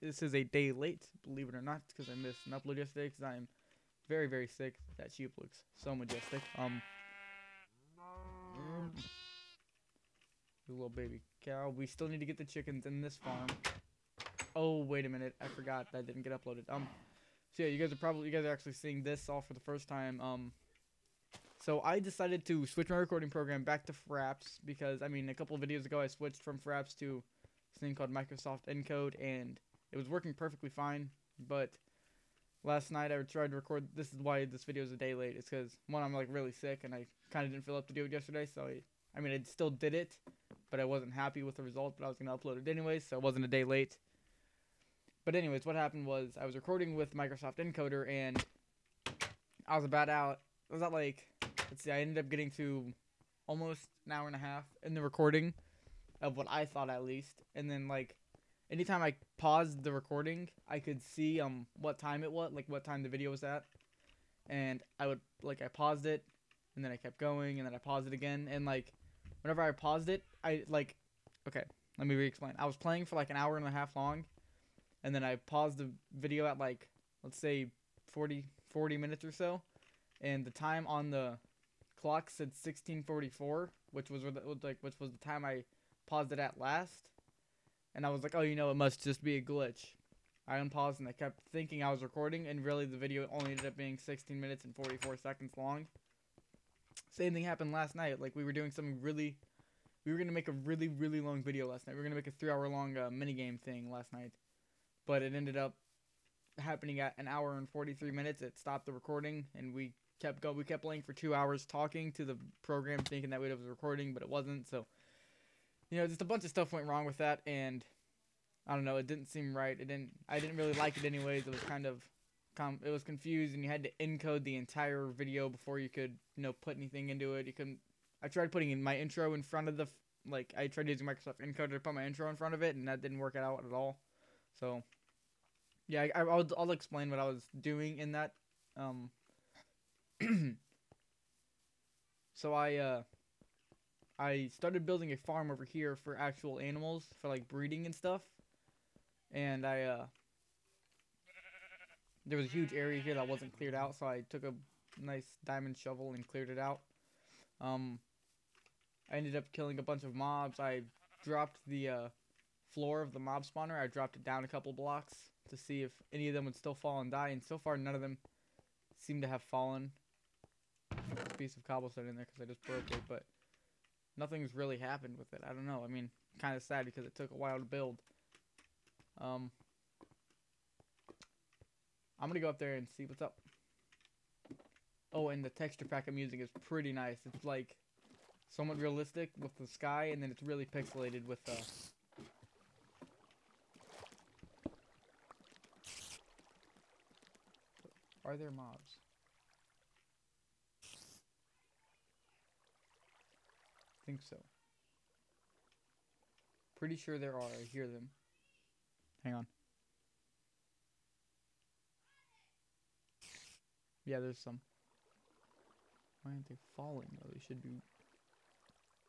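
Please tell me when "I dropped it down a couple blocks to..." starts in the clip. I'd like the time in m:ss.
2:43.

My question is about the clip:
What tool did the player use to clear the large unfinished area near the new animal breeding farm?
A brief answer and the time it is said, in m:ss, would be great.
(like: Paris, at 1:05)
diamond shovel, at 2:35.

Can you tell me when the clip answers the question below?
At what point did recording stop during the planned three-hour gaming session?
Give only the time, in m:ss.
1:47.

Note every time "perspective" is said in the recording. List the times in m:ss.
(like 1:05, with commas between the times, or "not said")
not said.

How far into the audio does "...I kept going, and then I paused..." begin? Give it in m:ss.
1:06.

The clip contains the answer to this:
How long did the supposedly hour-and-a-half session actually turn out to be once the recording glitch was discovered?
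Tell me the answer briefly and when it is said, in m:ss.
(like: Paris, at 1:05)
16 minutes and 44 seconds, at 1:33.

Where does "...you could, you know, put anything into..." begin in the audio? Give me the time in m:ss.
2:05.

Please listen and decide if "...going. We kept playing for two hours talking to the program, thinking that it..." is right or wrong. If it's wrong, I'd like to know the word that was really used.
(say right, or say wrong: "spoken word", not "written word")
right.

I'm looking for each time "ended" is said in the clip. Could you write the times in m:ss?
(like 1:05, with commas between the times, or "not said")
0:52, 1:33, 1:45, 2:39.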